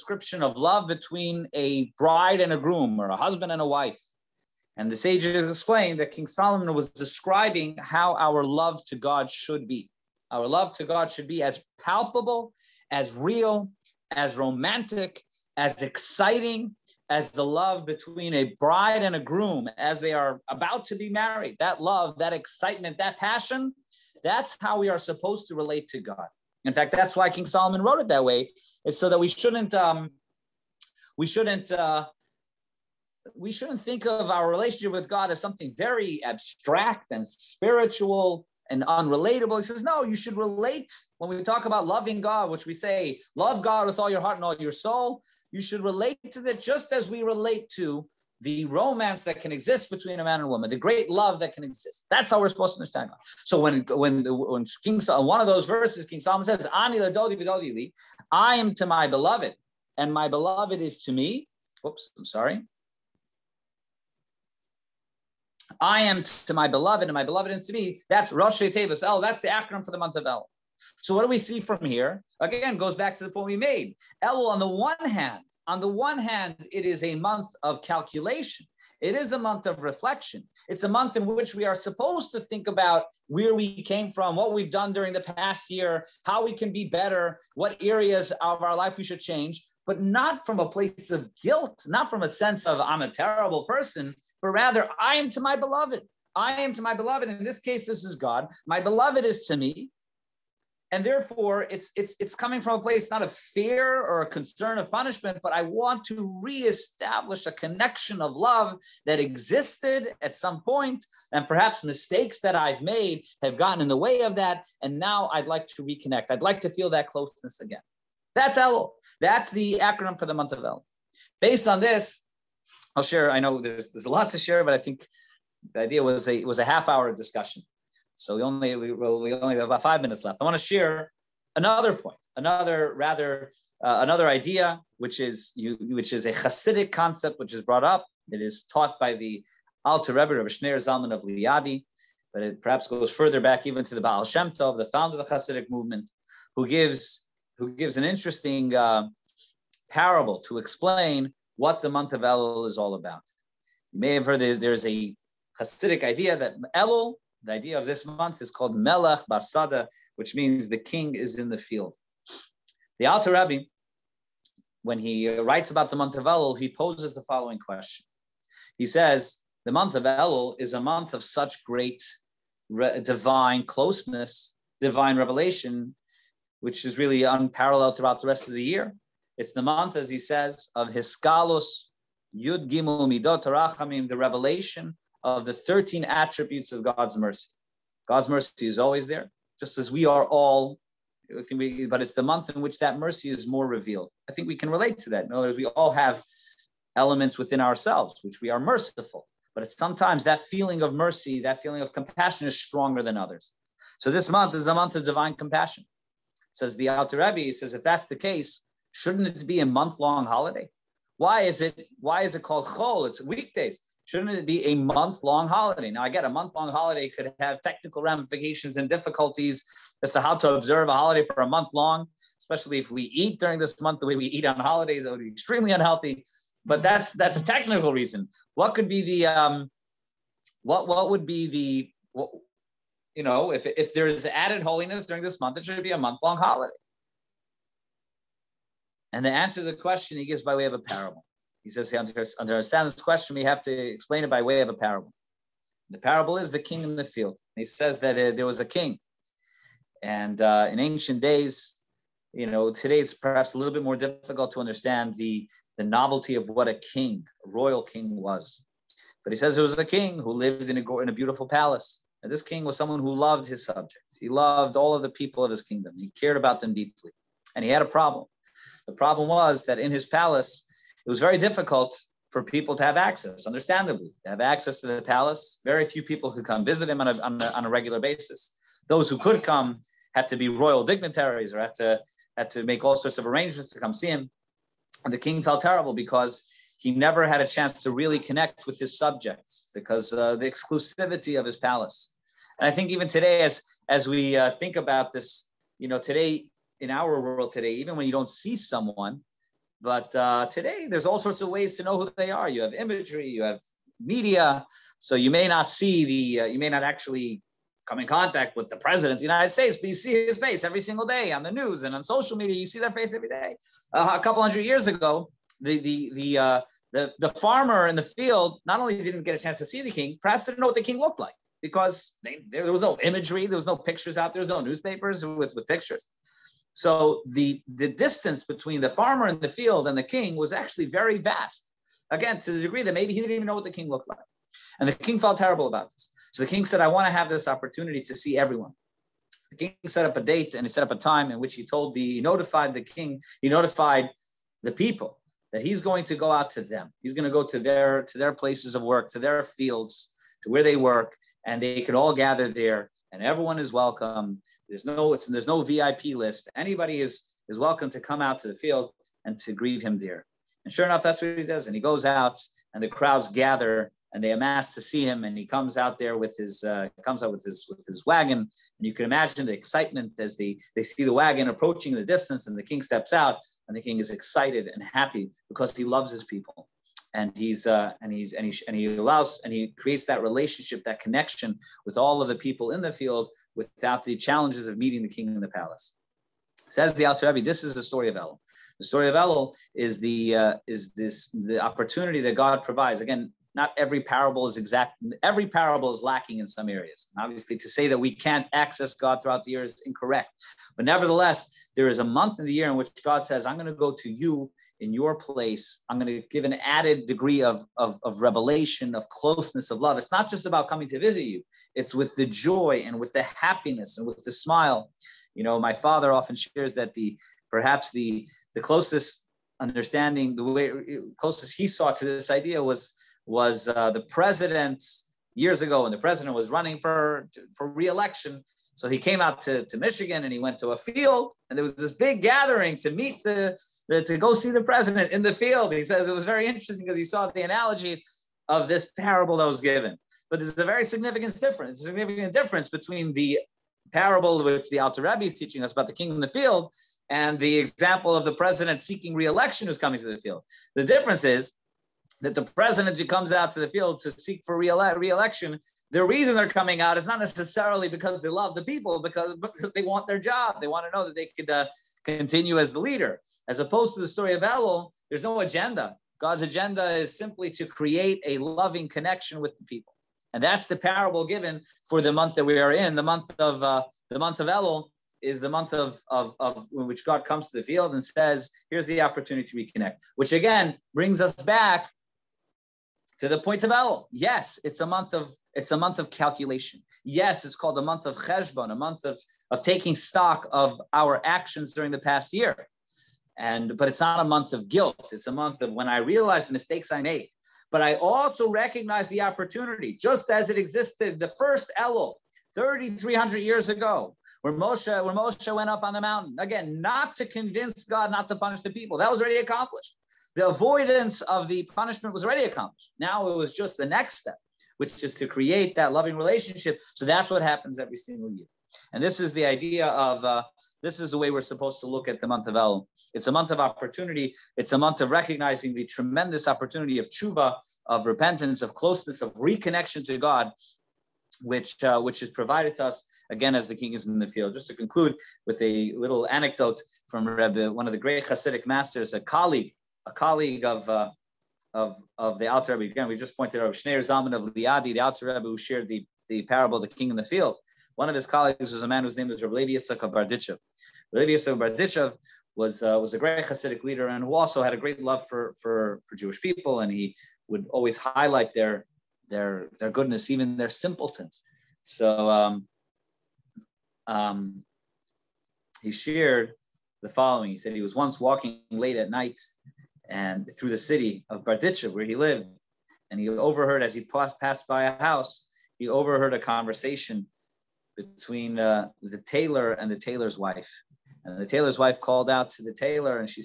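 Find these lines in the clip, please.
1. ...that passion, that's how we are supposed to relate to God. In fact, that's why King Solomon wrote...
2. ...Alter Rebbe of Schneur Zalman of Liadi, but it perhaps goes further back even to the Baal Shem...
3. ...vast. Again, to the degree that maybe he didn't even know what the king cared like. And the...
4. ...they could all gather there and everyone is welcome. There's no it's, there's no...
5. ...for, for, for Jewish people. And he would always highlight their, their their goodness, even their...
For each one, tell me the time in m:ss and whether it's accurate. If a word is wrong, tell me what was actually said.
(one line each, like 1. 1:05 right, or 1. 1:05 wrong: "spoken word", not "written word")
1. 0:22 right
2. 2:19 right
3. 5:31 wrong: "looked", not "cared"
4. 5:51 right
5. 9:15 right.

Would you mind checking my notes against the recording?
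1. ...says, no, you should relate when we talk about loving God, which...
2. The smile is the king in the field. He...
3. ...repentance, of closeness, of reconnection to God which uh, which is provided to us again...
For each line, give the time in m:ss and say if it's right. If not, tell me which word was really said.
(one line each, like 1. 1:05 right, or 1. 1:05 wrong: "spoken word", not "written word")
1. 0:39 right
2. 4:05 wrong: "parable", not "smile"
3. 8:48 right.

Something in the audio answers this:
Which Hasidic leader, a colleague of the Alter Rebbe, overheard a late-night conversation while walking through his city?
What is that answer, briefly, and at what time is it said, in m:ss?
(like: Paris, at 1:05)
Levi Yitzchak of Bardichev, at 9:09.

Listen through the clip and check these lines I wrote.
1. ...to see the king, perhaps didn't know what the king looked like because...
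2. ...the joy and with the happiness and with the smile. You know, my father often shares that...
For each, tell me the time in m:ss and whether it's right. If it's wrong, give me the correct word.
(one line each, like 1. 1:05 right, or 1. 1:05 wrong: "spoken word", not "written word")
1. 5:19 right
2. 6:52 right.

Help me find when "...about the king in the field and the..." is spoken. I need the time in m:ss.
7:25.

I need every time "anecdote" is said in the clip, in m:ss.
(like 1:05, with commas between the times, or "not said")
8:56.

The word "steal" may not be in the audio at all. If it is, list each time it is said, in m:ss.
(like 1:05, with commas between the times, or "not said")
not said.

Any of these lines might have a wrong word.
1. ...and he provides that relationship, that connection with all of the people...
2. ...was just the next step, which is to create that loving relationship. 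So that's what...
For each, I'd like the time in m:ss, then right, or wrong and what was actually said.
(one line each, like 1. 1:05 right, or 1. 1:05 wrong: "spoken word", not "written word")
1. 6:19 wrong: "creates", not "provides"
2. 8:33 right.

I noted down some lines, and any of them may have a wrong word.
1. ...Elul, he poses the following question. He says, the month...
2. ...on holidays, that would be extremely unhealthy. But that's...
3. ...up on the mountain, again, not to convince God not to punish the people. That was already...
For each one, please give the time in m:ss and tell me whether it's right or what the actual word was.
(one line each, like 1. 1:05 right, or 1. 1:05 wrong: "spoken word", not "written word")
1. 2:46 right
2. 3:44 right
3. 8:25 right.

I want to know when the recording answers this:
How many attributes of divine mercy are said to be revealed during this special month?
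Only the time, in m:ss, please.
3:05.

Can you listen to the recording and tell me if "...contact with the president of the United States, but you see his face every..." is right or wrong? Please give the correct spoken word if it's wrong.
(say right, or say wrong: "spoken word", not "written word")
right.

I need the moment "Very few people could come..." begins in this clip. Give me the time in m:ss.
4:35.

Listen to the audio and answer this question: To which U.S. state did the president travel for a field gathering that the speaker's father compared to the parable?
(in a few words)
Michigan.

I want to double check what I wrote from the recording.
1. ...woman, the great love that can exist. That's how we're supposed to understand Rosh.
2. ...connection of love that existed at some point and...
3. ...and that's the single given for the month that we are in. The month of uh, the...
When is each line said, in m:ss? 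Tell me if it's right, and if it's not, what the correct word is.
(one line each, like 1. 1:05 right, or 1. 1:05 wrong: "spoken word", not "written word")
1. 0:50 wrong: "God", not "Rosh"
2. 1:47 right
3. 7:50 wrong: "parable", not "single".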